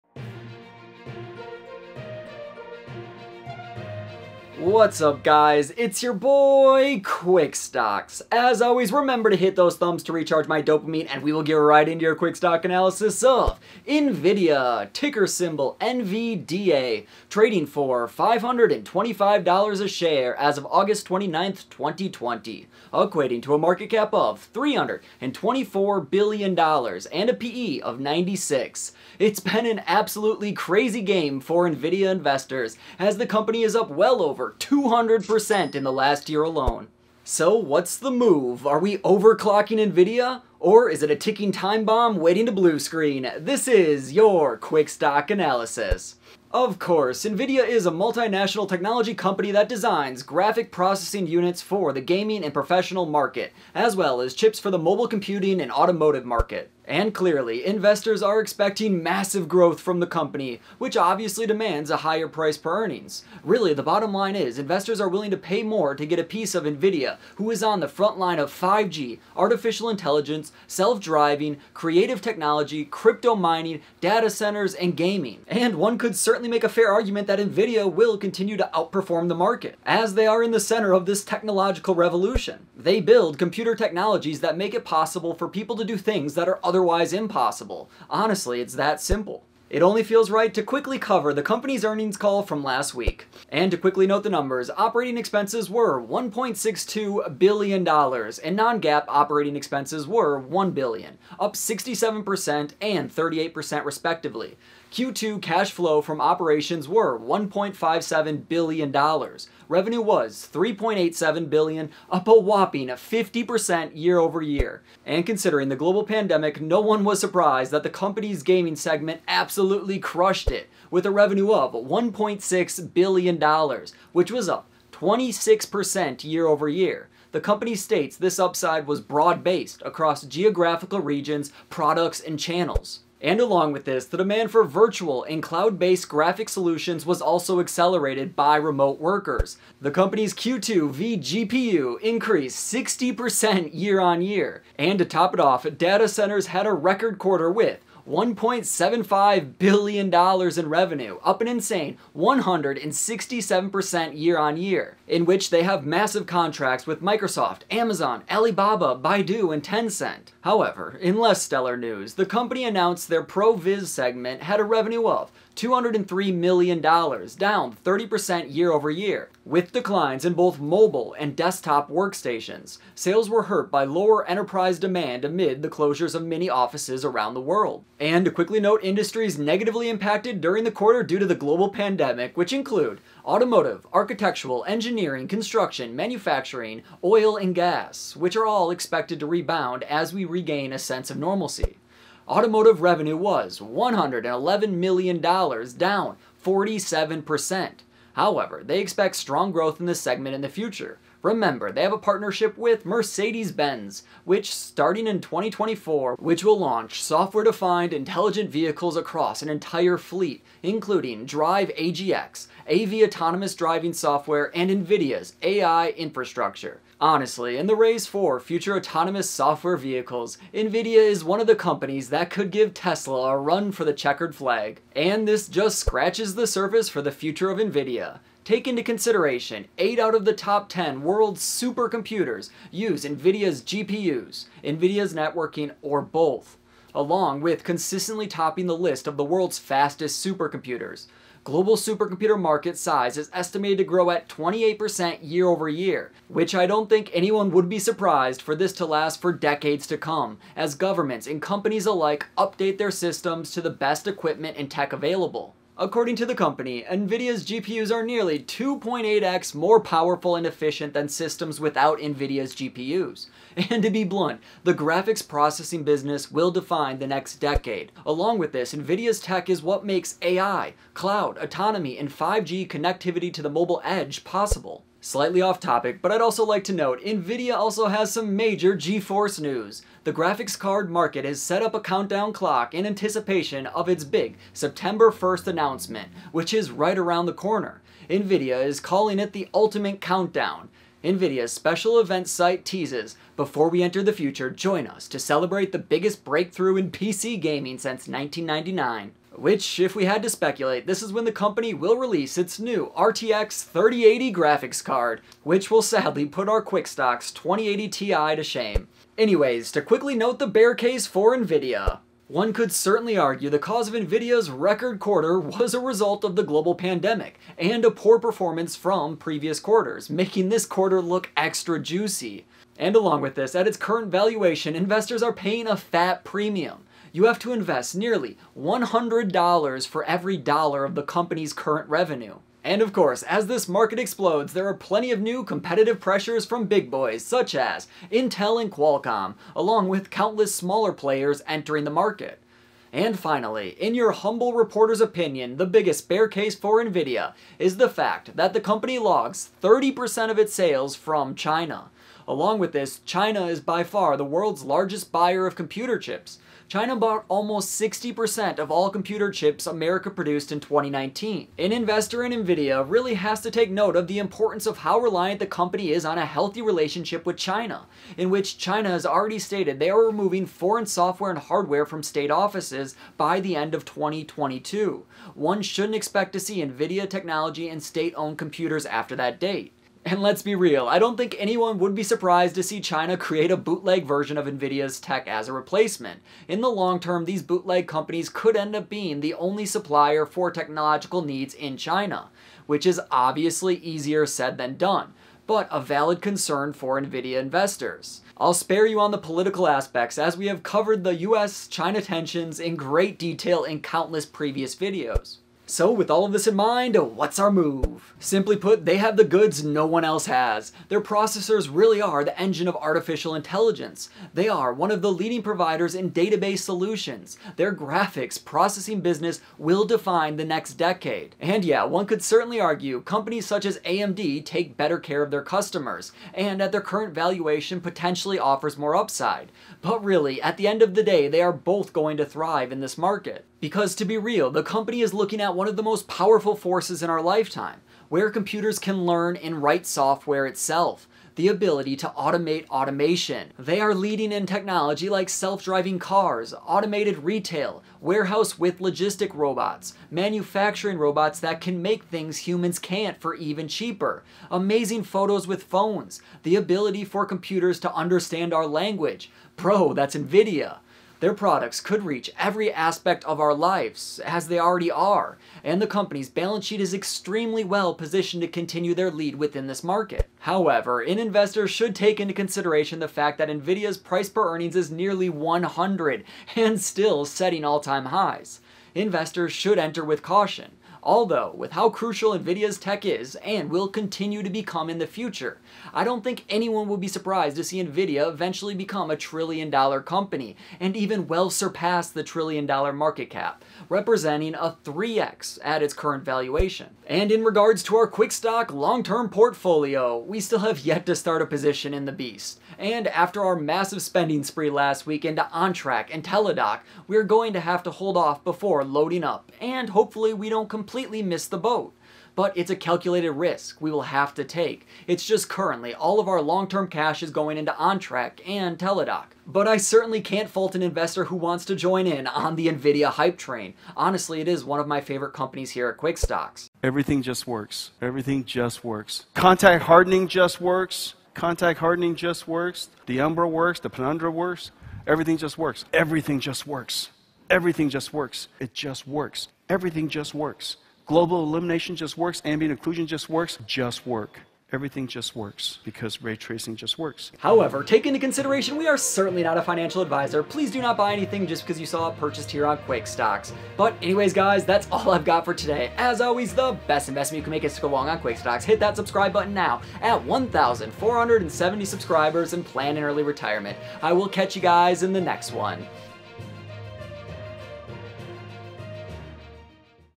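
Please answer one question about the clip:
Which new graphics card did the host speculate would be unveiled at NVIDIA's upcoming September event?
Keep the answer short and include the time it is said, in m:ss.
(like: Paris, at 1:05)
RTX 3080, at 5:02.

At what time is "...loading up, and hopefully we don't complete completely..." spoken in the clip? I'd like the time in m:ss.
8:28.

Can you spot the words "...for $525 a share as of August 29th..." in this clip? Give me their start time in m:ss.
0:17.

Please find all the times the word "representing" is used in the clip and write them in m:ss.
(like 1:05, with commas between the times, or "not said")
8:13.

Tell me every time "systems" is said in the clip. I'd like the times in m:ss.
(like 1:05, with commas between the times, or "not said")
4:12, 4:21.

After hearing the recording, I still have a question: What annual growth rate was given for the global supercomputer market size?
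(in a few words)
28%.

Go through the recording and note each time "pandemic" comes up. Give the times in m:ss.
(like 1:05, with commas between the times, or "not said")
1:56, 3:01, 5:16.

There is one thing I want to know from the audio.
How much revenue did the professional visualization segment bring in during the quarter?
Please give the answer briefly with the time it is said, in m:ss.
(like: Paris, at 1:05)
$203 million, at 2:45.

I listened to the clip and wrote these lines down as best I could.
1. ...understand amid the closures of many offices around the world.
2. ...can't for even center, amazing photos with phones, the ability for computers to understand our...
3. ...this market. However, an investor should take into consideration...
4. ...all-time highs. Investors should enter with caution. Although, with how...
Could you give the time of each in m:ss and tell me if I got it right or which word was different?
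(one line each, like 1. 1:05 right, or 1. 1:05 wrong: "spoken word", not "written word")
1. 2:54 wrong: "demand", not "understand"
2. 7:32 wrong: "cheaper", not "center"
3. 7:49 right
4. 7:57 right.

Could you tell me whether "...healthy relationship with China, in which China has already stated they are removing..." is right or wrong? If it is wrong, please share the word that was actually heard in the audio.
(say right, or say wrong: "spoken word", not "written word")
right.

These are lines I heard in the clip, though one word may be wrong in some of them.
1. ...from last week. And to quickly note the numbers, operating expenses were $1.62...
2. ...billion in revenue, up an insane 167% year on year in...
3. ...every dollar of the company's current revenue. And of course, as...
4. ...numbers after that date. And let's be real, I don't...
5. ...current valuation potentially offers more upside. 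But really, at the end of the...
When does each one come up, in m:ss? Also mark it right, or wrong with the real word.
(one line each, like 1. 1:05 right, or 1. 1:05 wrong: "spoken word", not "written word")
1. 1:32 right
2. 2:29 right
3. 5:30 right
4. 6:18 wrong: "computers", not "numbers"
5. 7:06 right.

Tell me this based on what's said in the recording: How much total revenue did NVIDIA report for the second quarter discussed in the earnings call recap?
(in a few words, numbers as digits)
$3.87 billion.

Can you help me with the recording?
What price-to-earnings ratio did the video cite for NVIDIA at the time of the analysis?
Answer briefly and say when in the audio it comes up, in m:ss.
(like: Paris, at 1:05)
96, at 0:27.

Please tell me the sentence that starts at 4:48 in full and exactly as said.
Nvidia is calling it the ultimate countdown.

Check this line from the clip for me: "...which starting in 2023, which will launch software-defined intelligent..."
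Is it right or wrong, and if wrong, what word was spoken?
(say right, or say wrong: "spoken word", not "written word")
wrong: "2024", not "2023".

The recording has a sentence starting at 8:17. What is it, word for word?
And in regards to our quick stock long-term portfolio, we still have yet to start a position in the beast.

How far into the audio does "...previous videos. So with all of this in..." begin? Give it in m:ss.
6:44.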